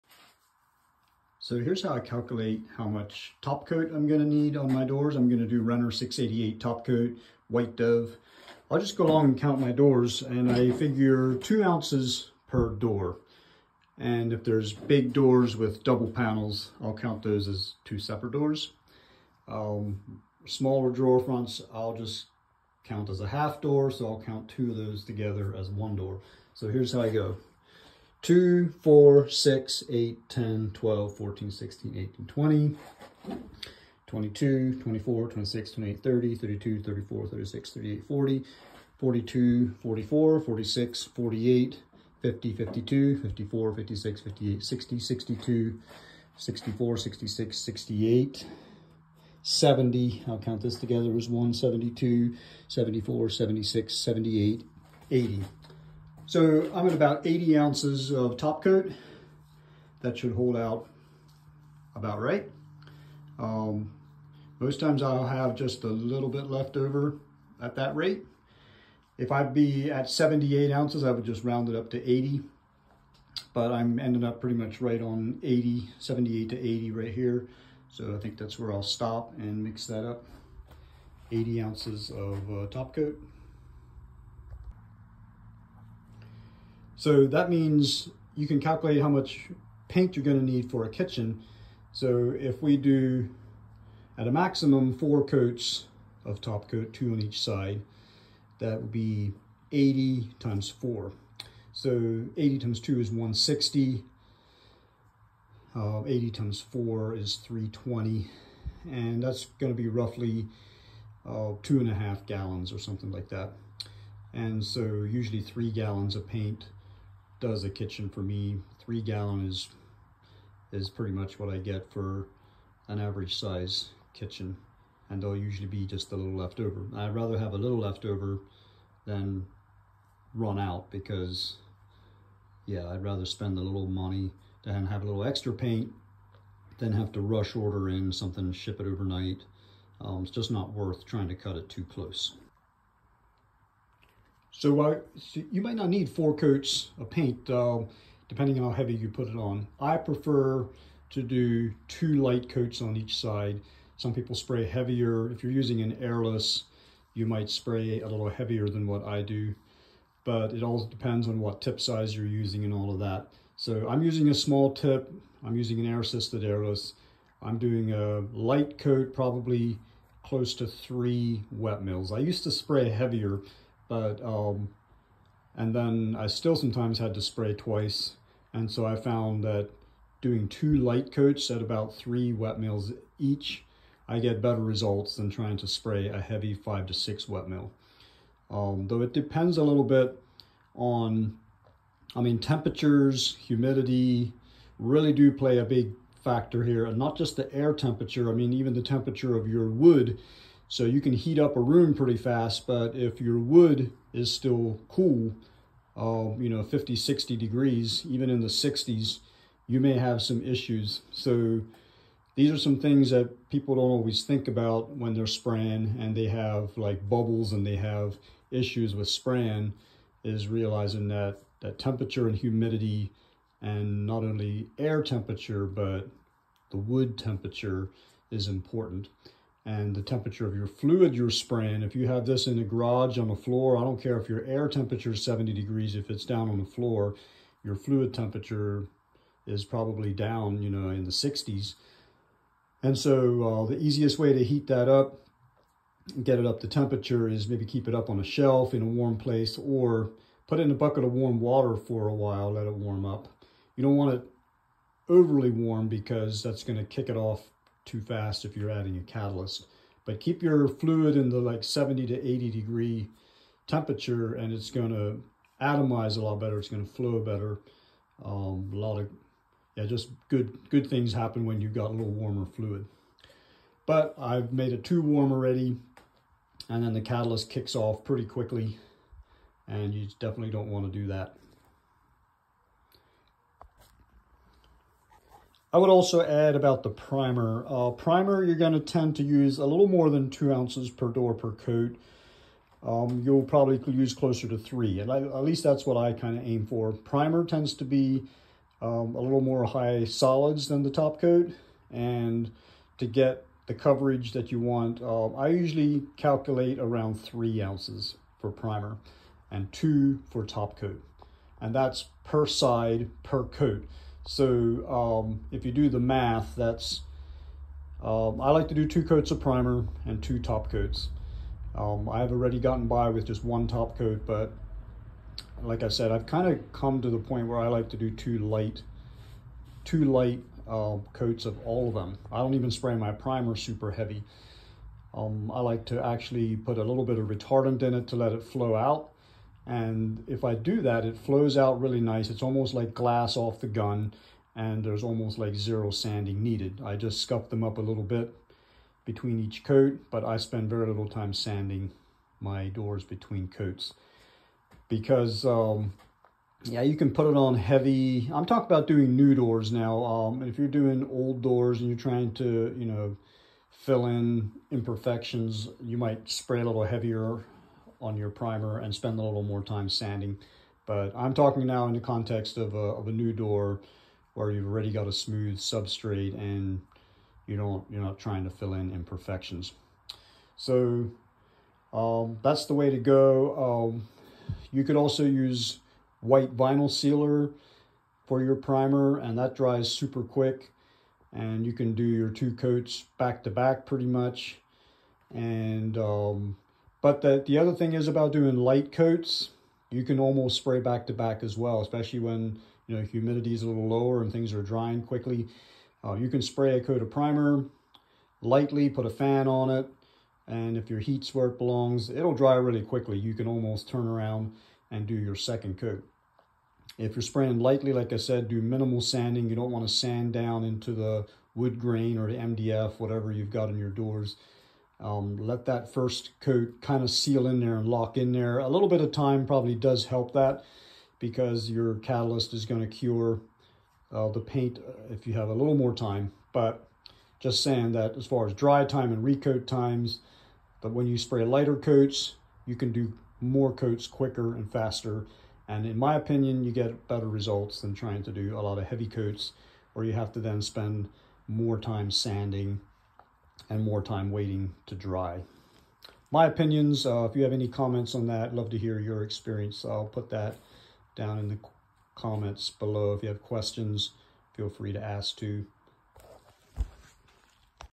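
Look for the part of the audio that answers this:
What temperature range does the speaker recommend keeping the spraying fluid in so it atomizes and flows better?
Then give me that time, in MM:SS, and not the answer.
04:21.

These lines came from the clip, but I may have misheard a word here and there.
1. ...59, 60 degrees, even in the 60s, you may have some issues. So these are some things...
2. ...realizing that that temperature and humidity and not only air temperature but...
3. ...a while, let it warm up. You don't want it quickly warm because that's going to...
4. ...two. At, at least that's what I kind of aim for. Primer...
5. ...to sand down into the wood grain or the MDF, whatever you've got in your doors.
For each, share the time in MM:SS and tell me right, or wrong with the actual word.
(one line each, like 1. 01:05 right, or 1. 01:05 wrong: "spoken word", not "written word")
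1. 03:26 wrong: "50", not "59"
2. 03:40 right
3. 04:12 wrong: "overly", not "quickly"
4. 04:54 wrong: "three", not "two"
5. 06:59 right.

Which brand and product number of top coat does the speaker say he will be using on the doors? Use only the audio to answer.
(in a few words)
Renner 688.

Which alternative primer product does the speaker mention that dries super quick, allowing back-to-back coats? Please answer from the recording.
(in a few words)
white vinyl sealer.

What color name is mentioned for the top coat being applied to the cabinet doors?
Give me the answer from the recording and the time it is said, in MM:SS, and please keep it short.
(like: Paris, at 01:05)
White Dove, at 00:07.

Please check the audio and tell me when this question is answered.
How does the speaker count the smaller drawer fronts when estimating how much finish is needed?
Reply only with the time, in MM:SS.
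00:23.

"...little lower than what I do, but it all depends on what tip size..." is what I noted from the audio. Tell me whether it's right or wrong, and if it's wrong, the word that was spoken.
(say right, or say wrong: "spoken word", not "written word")
wrong: "heavier", not "lower".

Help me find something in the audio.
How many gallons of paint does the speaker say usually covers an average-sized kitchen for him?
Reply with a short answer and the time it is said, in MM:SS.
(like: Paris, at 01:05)
3, at 01:55.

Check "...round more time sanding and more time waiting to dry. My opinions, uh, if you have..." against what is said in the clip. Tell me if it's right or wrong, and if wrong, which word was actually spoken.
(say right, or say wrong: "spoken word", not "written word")
wrong: "spend", not "round".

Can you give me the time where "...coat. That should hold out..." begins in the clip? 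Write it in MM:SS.
00:58.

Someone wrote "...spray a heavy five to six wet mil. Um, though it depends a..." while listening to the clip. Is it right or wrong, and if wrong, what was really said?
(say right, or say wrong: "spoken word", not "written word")
right.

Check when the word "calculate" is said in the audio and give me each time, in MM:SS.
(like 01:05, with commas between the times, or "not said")
00:01, 01:28, 05:06.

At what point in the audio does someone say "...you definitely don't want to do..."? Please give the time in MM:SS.
04:39.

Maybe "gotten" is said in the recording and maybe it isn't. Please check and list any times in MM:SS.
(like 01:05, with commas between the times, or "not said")
05:22.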